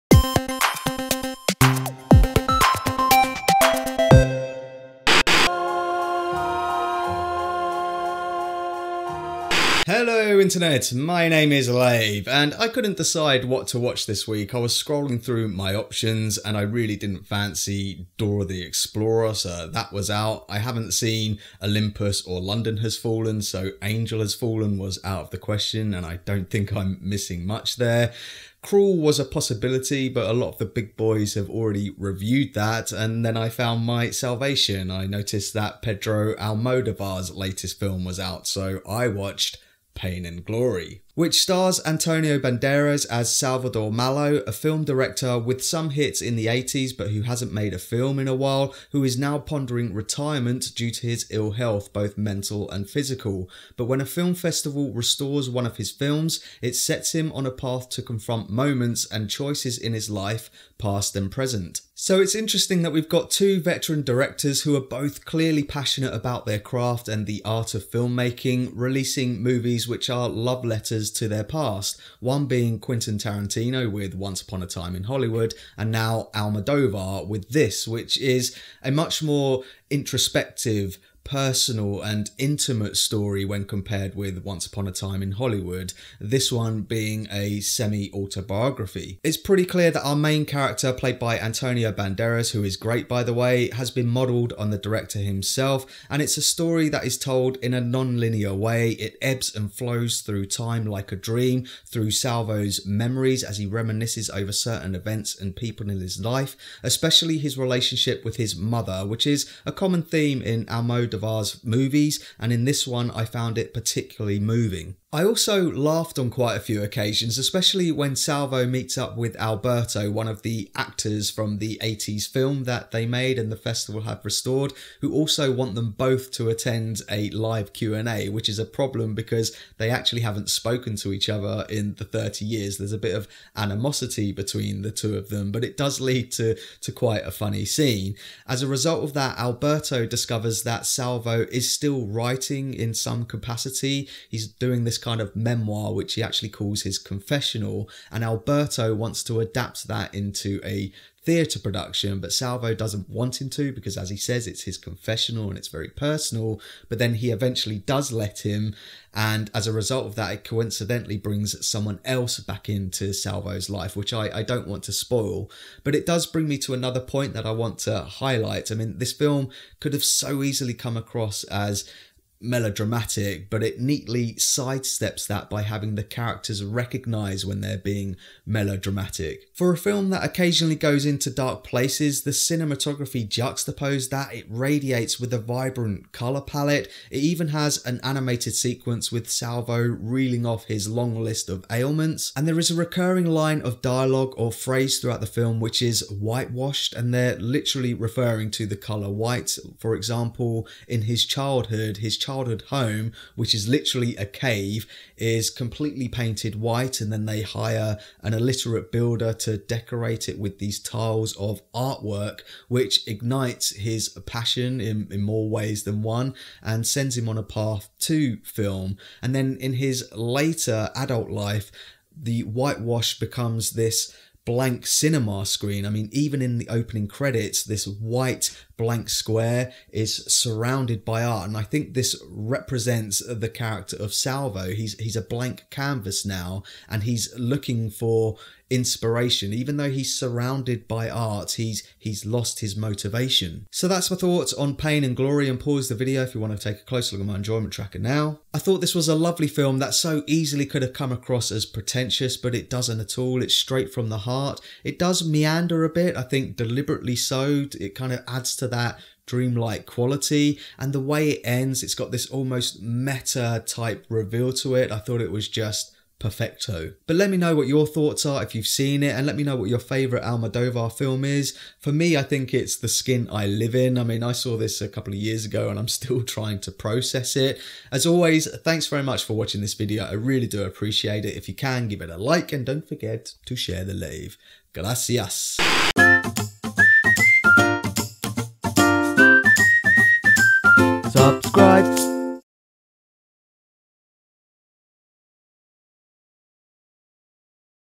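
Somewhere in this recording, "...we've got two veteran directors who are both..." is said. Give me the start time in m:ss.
1:02.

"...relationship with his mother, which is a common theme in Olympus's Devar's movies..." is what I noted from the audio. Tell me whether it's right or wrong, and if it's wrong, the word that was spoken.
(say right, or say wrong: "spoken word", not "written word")
wrong: "Almodovar", not "Olympus".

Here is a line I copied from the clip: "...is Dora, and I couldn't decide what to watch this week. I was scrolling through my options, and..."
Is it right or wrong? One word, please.
wrong.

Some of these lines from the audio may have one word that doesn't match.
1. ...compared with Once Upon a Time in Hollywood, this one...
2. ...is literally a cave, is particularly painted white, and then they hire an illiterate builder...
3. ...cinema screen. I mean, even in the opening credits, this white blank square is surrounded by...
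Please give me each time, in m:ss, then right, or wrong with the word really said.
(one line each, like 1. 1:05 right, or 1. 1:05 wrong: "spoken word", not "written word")
1. 1:23 right
2. 3:23 wrong: "completely", not "particularly"
3. 3:44 right.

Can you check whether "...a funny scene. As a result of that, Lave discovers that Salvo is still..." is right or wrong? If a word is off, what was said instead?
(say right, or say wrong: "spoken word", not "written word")
wrong: "Alberto", not "Lave".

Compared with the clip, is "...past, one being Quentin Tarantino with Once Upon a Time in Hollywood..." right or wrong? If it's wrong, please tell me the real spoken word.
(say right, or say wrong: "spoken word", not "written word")
right.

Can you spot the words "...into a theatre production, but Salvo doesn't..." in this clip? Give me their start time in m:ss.
2:30.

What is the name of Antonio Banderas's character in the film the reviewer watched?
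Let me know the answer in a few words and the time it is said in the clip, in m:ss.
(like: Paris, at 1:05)
Salvador Malo, at 0:43.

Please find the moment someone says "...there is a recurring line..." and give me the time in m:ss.
3:12.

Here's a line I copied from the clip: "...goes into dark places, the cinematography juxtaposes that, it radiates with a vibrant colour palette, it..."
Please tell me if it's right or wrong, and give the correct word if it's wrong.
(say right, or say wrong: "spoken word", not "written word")
right.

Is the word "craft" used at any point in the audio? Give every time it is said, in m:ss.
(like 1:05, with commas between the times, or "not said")
1:06.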